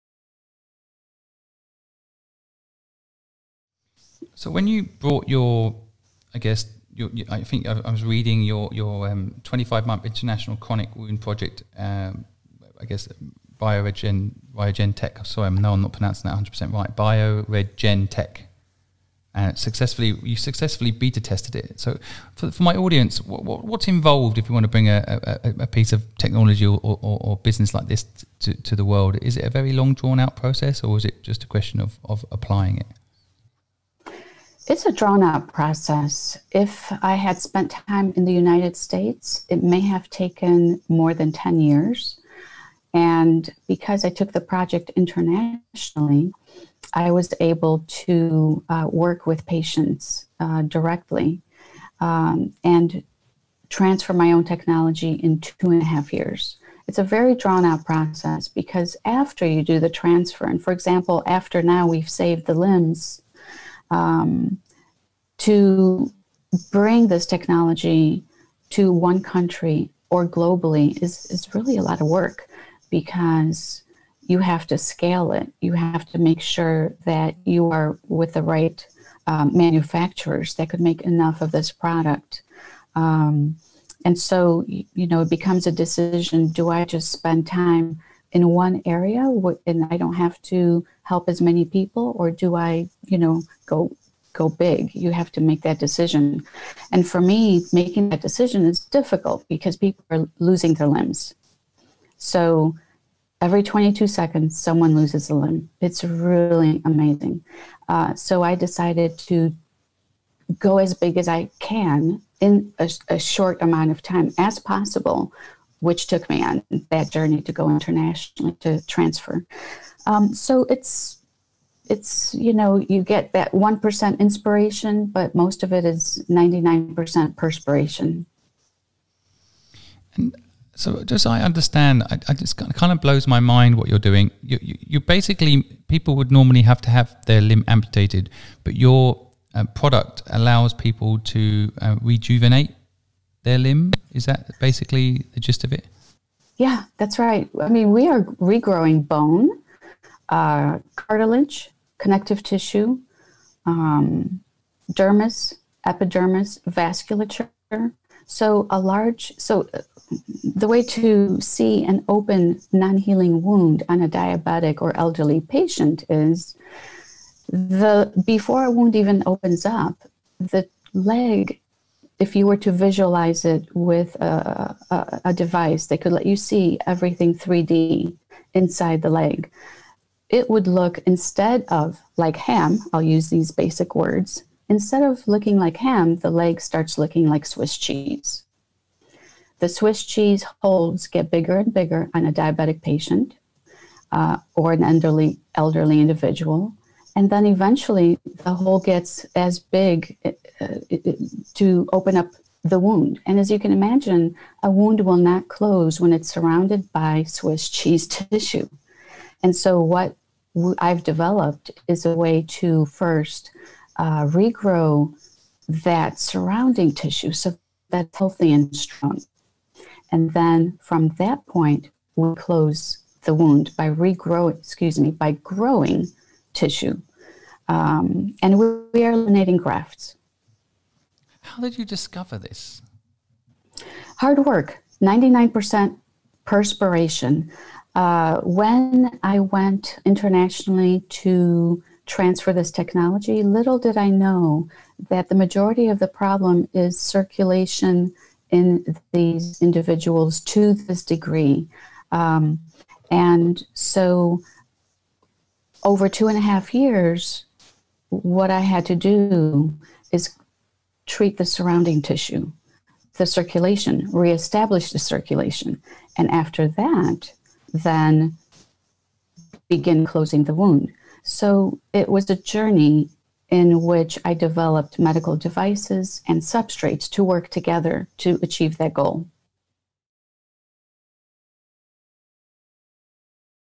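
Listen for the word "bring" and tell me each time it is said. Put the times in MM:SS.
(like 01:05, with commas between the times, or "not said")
00:24, 01:06.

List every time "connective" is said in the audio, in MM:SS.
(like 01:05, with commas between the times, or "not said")
02:31.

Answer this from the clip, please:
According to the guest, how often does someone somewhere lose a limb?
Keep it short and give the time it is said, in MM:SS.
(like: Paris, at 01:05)
every 22 seconds, at 01:43.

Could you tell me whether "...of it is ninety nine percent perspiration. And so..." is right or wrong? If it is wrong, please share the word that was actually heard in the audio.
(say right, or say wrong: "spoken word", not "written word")
right.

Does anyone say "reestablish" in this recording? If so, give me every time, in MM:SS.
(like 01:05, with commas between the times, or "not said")
04:24.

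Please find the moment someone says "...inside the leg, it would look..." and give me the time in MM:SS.
02:58.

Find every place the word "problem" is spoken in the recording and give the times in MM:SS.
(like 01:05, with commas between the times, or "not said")
04:06.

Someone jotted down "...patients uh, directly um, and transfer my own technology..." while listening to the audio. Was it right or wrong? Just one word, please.
right.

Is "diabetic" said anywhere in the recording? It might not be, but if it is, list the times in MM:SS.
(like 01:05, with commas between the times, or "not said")
02:44, 03:12.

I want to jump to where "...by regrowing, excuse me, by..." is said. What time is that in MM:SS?
03:43.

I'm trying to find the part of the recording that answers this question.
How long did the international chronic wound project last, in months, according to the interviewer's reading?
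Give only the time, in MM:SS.
00:09.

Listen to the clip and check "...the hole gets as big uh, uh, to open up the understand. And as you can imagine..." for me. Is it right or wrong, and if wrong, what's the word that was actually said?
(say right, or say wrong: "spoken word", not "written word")
wrong: "wound", not "understand".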